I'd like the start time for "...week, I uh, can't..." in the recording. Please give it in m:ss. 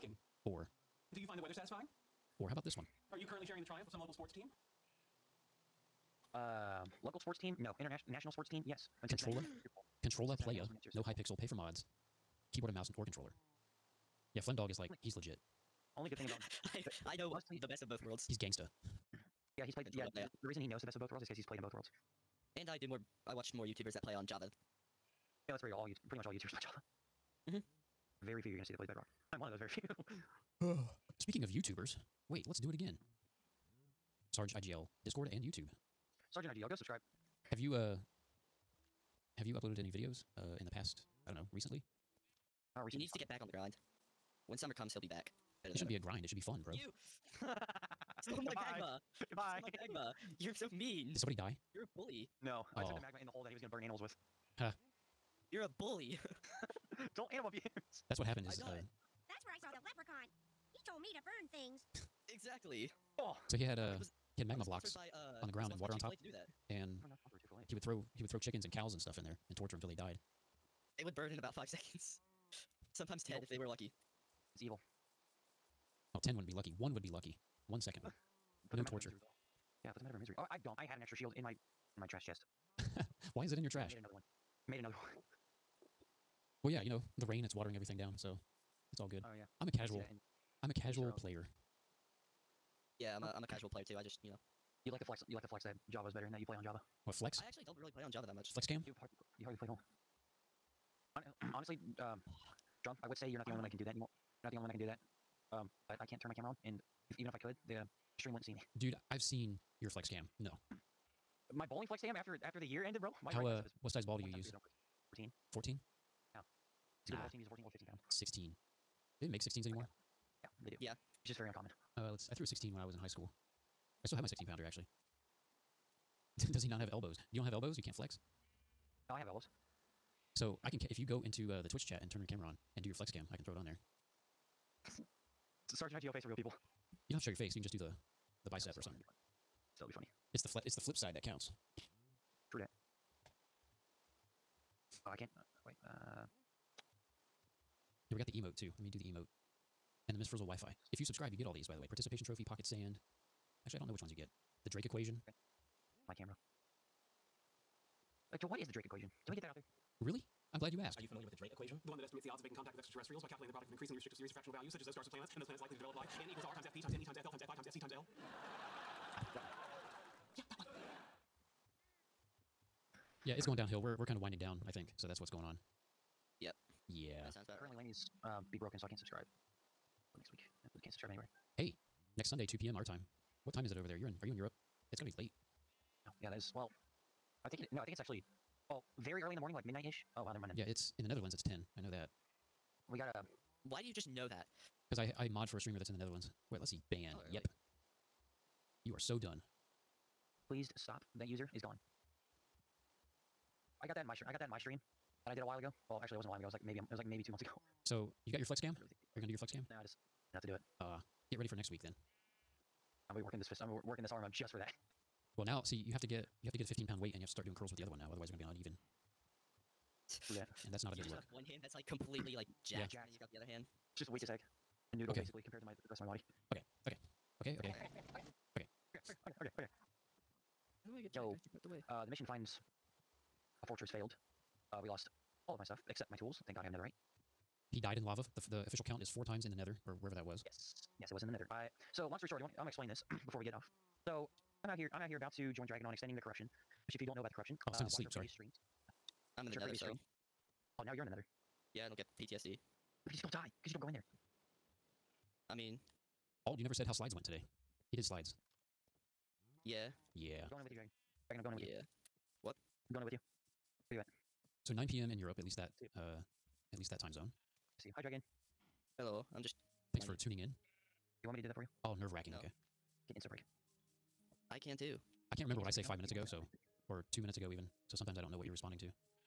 3:00.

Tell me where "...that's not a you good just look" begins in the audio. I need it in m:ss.
3:40.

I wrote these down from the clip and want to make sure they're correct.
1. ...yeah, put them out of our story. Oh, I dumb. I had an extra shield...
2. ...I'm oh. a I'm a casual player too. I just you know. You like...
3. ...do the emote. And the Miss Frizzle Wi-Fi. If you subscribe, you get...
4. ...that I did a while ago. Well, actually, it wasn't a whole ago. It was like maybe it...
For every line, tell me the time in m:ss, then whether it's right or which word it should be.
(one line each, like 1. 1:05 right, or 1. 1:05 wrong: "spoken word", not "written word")
1. 1:19 wrong: "misery", not "story"
2. 1:33 right
3. 2:28 right
4. 3:25 wrong: "while", not "whole".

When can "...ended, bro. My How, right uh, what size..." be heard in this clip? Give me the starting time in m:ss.
1:52.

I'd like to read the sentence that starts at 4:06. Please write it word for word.
Which if you don't know about the corruption, oh it's time uh, to sleep, sorry.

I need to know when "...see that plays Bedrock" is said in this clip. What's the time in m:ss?
0:28.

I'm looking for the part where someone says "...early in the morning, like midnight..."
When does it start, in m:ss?
3:09.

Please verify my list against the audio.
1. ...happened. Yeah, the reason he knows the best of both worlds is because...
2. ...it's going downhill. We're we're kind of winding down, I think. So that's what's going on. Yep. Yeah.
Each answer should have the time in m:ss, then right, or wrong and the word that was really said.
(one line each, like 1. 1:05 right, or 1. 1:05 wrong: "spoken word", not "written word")
1. 0:19 wrong: "played", not "happened"
2. 2:53 right.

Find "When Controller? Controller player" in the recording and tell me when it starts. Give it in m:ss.
0:09.